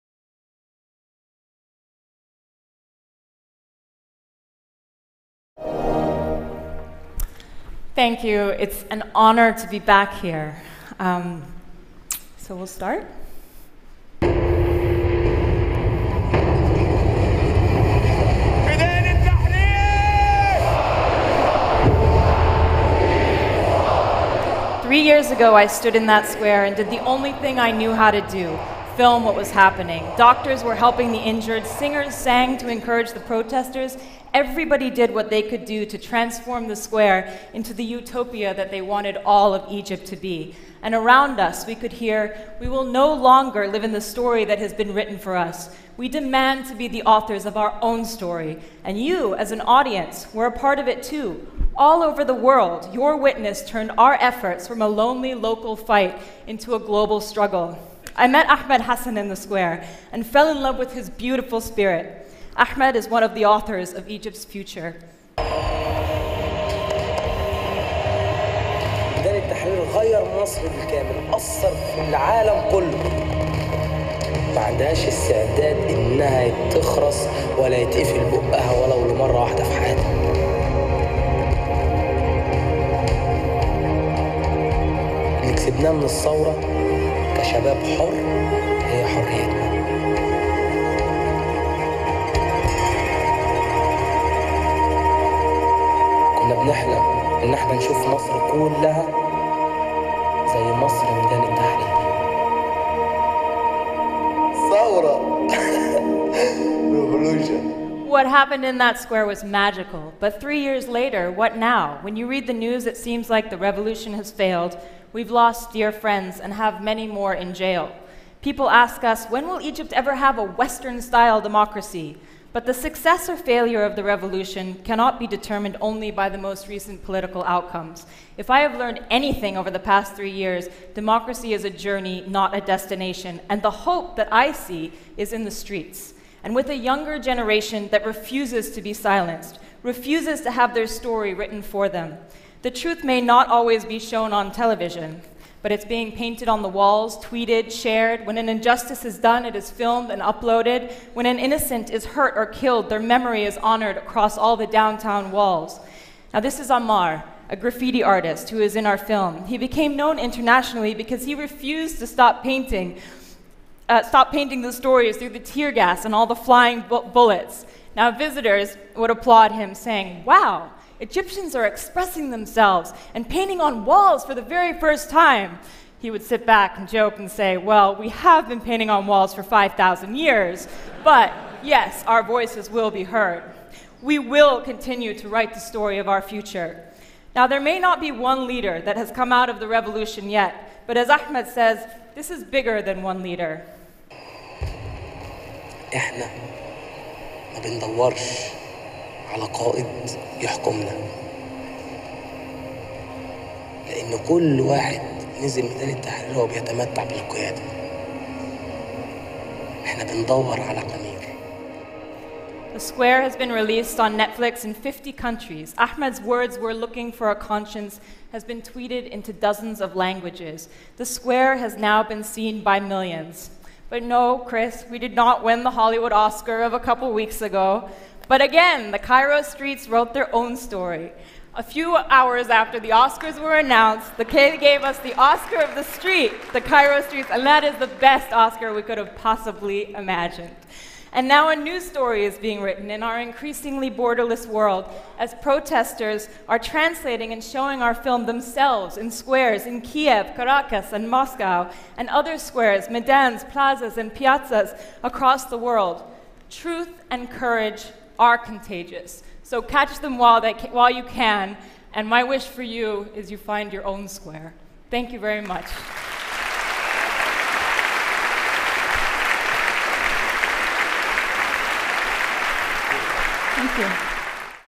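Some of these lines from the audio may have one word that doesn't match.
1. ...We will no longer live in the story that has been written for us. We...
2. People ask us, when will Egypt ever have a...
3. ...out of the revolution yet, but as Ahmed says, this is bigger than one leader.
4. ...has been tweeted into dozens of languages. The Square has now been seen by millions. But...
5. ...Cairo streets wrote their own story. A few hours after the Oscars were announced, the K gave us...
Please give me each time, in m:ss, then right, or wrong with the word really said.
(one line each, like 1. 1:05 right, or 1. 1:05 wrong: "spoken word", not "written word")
1. 0:42 right
2. 1:58 right
3. 3:09 right
4. 3:38 right
5. 3:48 right.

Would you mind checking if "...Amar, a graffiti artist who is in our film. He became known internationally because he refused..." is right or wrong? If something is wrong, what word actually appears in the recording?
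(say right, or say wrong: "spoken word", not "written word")
right.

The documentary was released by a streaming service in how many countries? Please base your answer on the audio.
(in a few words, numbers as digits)
50.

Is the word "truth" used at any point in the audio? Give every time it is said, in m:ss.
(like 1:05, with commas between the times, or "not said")
2:22, 4:16.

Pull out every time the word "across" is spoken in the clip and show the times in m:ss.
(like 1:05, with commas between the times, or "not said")
2:33, 4:15.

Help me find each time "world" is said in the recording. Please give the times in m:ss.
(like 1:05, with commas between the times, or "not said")
0:52, 4:04, 4:15.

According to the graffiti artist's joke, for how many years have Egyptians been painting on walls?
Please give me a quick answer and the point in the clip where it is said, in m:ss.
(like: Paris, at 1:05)
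5,000 years, at 2:59.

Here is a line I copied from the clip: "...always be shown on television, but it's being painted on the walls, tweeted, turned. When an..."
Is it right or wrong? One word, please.
wrong.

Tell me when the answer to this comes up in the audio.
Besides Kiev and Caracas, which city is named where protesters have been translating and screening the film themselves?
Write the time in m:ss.
4:11.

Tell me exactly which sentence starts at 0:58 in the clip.
I met Ahmed Hassan in the square and fell in love with his beautiful spirit.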